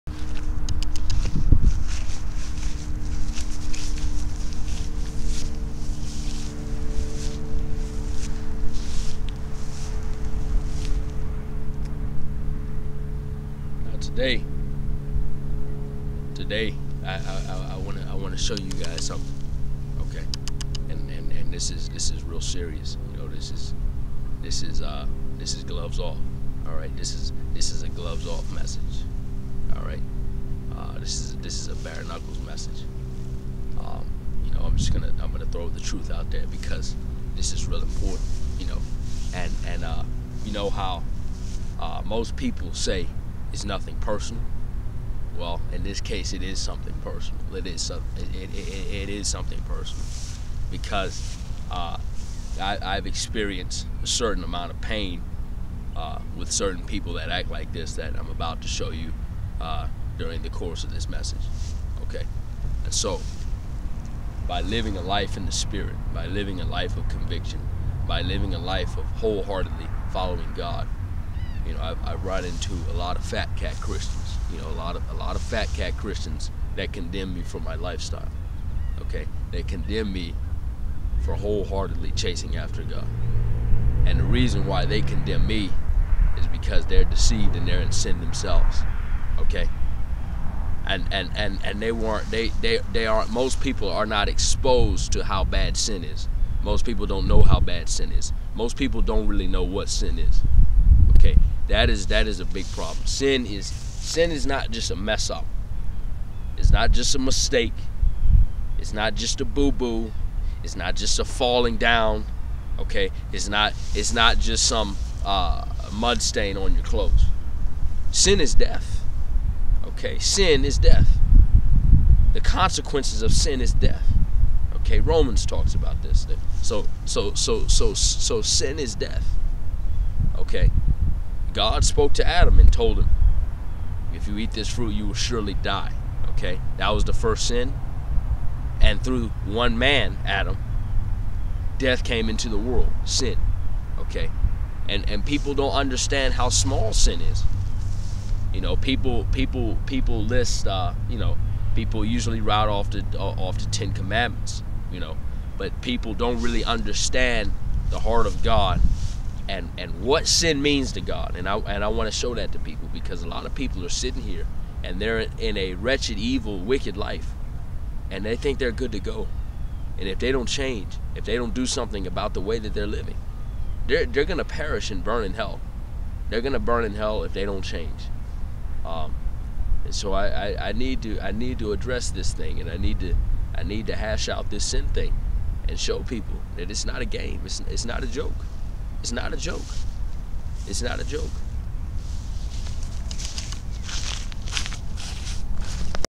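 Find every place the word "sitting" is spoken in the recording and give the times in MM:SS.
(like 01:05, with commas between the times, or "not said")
02:43.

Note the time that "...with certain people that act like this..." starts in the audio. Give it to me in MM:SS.
00:56.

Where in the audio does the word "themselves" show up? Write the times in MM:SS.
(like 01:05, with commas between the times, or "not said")
01:28.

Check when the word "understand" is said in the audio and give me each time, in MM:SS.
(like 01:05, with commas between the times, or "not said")
02:25, 02:36.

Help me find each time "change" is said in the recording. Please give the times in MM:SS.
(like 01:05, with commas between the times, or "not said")
02:50, 02:57.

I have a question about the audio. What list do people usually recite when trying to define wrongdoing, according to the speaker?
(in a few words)
the 10 commandments.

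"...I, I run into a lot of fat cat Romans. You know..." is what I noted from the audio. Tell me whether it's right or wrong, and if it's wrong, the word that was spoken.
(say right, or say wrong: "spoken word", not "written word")
wrong: "Christians", not "Romans".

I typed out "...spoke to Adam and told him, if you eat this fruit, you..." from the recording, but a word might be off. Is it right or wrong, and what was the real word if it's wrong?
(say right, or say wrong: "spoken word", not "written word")
right.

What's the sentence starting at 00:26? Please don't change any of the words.
All right, this is this is a gloves off message.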